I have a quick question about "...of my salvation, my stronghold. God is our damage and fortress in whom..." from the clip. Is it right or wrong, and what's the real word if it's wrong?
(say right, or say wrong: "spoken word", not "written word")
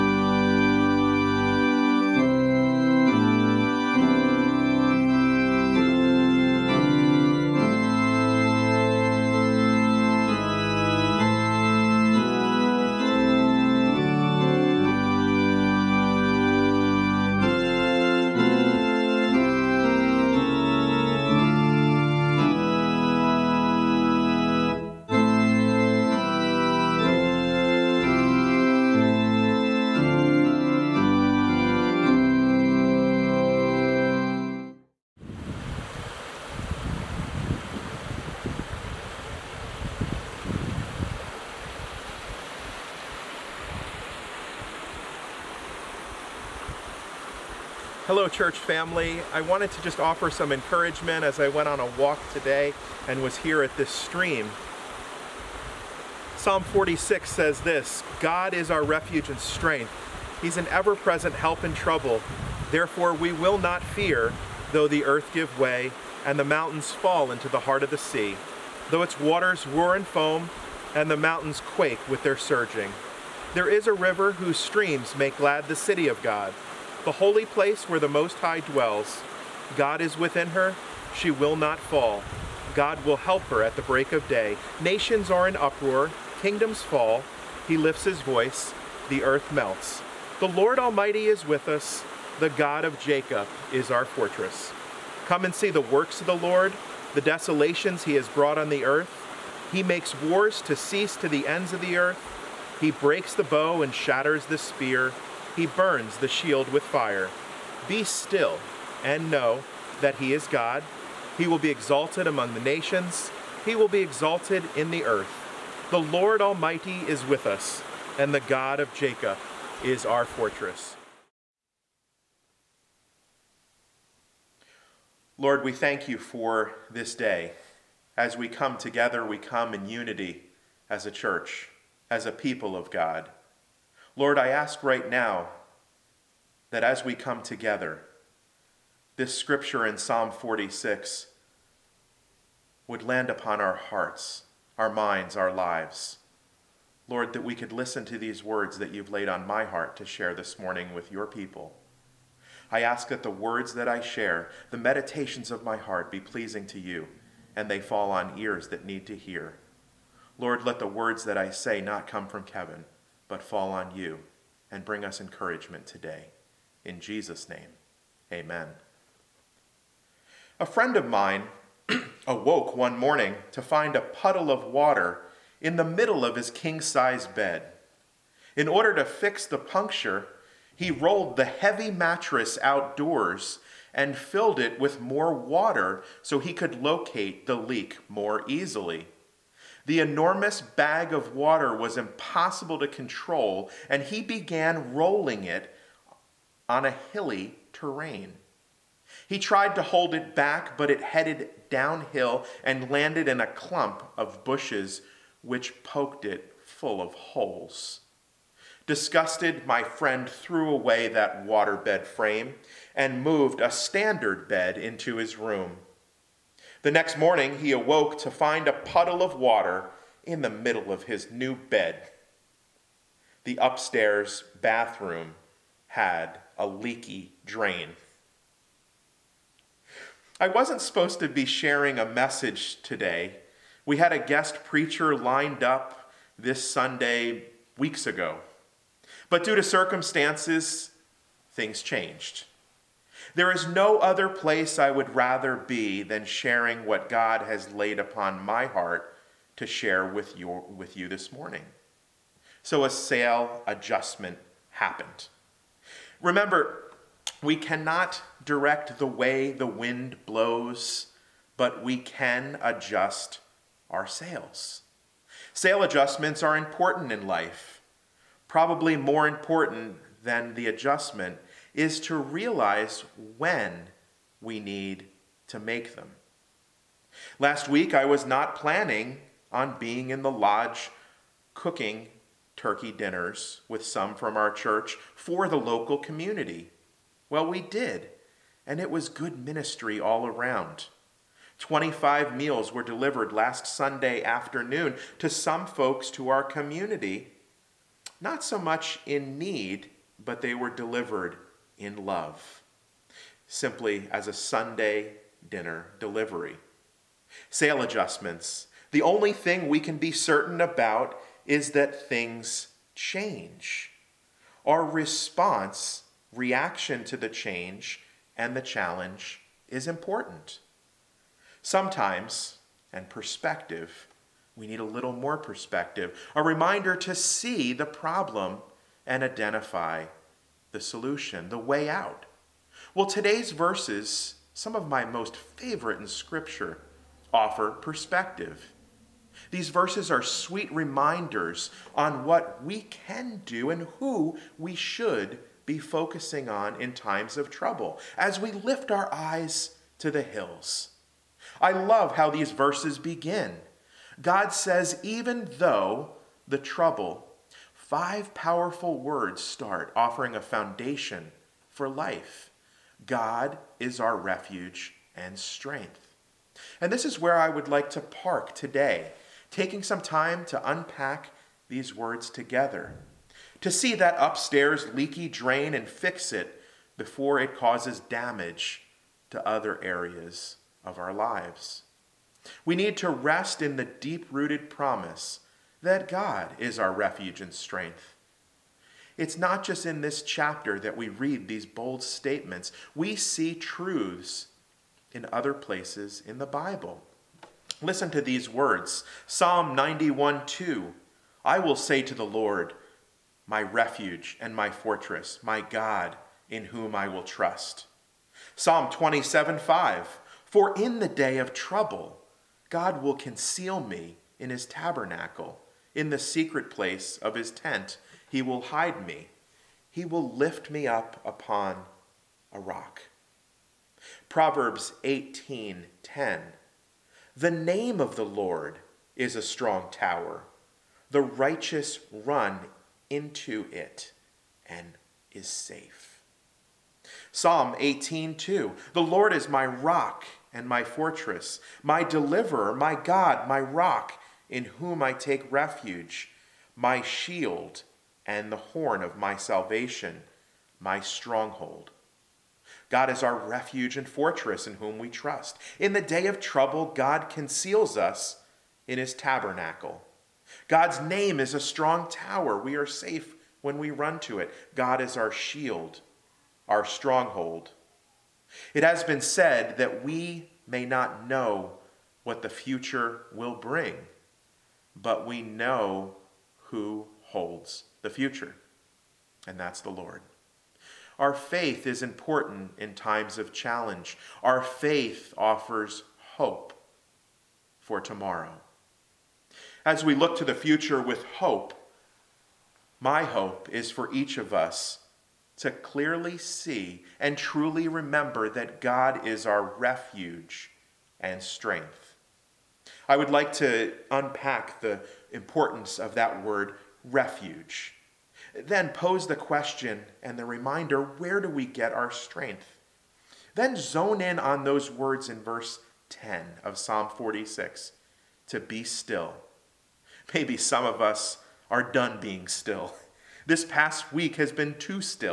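wrong: "refuge", not "damage".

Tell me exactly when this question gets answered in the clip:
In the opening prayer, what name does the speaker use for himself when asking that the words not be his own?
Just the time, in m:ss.
2:42.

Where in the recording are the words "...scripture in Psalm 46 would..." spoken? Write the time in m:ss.
2:19.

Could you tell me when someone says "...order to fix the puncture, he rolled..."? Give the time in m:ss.
2:58.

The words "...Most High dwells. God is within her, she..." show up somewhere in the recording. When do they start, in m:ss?
1:18.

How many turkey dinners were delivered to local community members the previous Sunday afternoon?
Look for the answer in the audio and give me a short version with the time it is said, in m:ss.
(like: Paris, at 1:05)
25, at 4:51.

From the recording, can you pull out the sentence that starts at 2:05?
Lord, we thank you for this day.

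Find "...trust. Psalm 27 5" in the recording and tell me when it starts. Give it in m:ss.
6:47.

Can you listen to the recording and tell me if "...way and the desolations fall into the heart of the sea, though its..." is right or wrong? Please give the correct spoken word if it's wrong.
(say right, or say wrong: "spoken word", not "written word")
wrong: "mountains", not "desolations".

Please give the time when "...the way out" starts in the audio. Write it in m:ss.
5:31.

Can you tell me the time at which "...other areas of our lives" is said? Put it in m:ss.
6:19.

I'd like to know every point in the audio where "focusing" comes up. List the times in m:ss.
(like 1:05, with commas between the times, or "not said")
5:45.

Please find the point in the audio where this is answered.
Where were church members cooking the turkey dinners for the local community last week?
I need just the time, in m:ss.
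4:40.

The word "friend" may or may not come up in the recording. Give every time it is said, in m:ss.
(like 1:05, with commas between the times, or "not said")
2:50, 3:29.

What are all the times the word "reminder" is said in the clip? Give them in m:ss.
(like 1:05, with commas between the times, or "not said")
5:26, 5:40, 8:30.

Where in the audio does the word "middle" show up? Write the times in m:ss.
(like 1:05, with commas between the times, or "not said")
2:55, 3:40.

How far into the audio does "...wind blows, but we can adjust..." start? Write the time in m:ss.
4:19.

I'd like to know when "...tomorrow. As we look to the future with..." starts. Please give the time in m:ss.
8:07.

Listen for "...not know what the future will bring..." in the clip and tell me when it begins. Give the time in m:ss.
7:50.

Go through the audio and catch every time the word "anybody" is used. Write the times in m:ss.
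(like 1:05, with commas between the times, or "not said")
not said.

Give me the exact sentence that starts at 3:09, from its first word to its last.
The enormous bag of water was impossible to control, and he began rolling it on a hilly terrain.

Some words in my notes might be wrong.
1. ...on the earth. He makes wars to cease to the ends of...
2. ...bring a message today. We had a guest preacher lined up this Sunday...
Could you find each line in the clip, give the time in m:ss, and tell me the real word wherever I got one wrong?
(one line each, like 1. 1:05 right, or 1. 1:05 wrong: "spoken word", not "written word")
1. 1:38 right
2. 3:51 wrong: "sharing", not "bring".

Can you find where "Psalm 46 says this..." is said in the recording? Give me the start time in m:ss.
0:56.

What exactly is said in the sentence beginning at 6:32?
We see truths in other places in the Bible.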